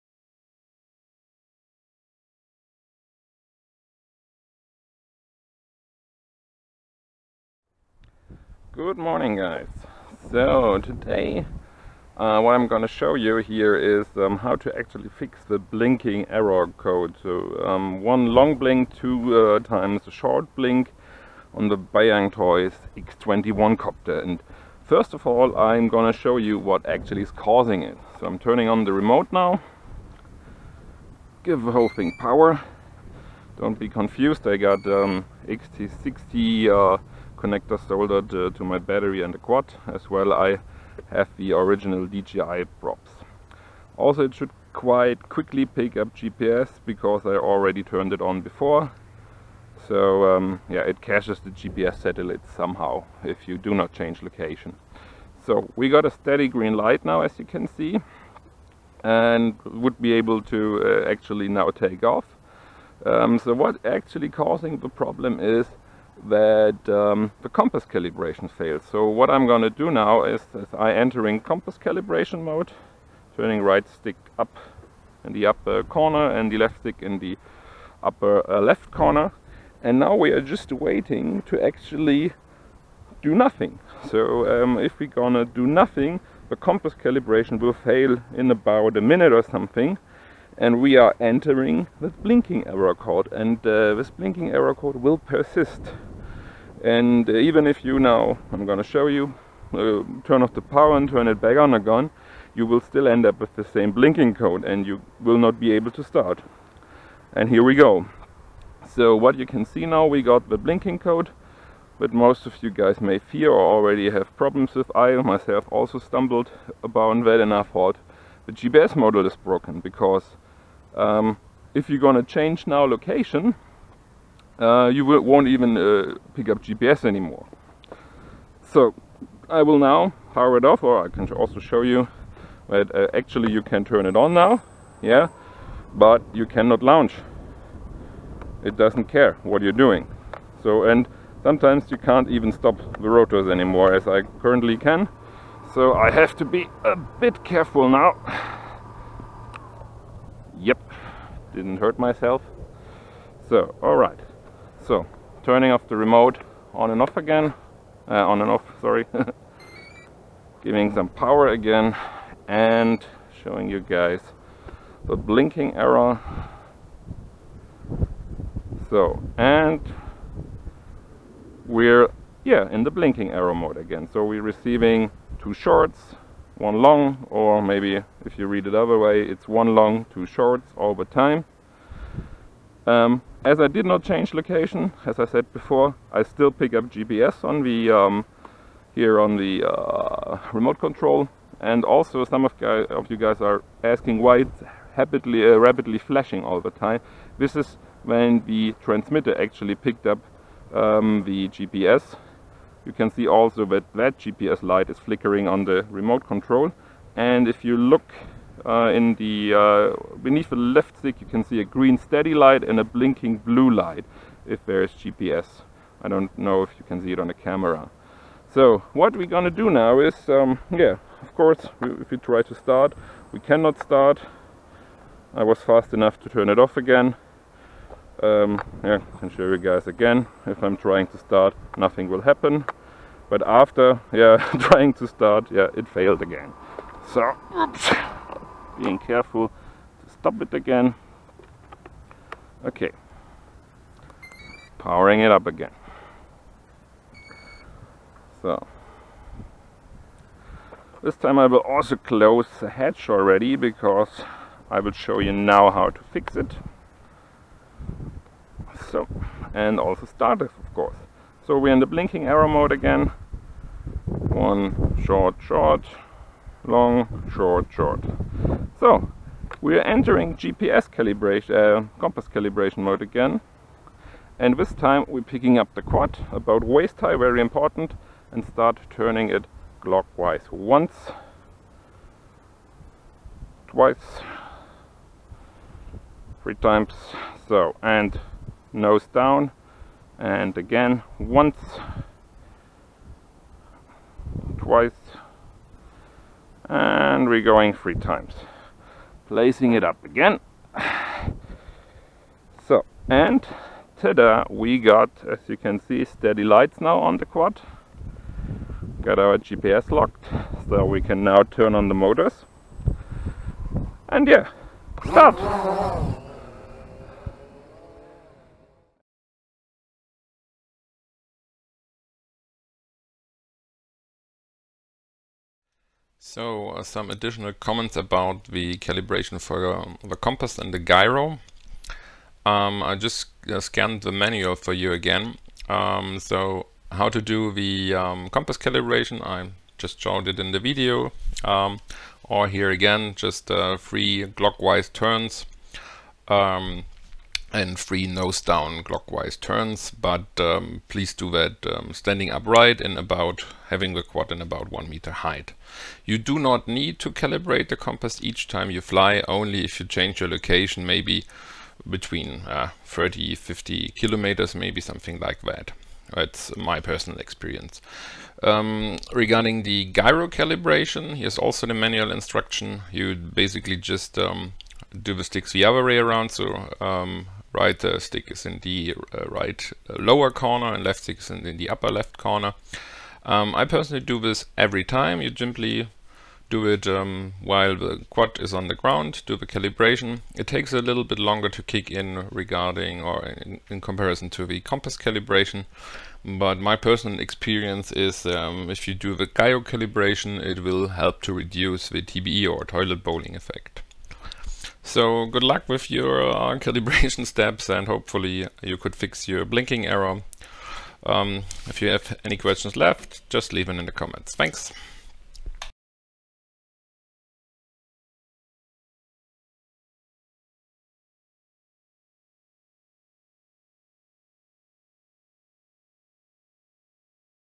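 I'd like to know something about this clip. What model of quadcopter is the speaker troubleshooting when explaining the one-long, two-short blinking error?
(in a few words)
Bayangtoys X21.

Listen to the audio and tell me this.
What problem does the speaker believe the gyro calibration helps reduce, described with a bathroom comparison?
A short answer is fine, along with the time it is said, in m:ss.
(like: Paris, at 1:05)
toilet bowling effect, at 6:42.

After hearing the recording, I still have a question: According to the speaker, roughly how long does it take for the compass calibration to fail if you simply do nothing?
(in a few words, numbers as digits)
about a minute.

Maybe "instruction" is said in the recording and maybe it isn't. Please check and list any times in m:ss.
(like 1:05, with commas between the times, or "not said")
6:12.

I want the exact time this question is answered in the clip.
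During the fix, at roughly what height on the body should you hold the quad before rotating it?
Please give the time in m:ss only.
4:36.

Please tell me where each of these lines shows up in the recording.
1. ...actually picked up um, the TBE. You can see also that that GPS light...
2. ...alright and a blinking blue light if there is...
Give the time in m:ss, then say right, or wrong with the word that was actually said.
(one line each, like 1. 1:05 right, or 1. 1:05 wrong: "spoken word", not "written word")
1. 3:19 wrong: "GPS", not "TBE"
2. 3:32 wrong: "light", not "alright".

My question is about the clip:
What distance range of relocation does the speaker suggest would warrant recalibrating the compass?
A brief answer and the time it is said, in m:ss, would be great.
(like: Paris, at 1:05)
30 to 50 kilometers, at 6:02.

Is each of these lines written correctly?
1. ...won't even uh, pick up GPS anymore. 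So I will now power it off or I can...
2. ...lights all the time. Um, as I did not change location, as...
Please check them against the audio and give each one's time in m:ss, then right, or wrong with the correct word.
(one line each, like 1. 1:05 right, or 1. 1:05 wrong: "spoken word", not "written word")
1. 2:05 right
2. 3:00 wrong: "shorts", not "lights".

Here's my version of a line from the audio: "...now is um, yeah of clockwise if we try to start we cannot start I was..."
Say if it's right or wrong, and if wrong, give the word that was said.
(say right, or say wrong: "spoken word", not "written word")
wrong: "course", not "clockwise".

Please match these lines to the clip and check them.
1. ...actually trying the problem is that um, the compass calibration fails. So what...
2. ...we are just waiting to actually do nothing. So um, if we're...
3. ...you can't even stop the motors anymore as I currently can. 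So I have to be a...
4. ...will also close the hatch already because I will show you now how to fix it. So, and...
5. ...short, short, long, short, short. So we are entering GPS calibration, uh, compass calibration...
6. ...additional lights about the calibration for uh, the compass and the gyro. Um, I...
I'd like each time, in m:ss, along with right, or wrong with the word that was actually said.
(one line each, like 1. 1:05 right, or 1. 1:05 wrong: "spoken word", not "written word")
1. 1:03 wrong: "causing", not "trying"
2. 1:20 right
3. 2:21 wrong: "rotors", not "motors"
4. 4:11 right
5. 4:25 right
6. 5:27 wrong: "comments", not "lights".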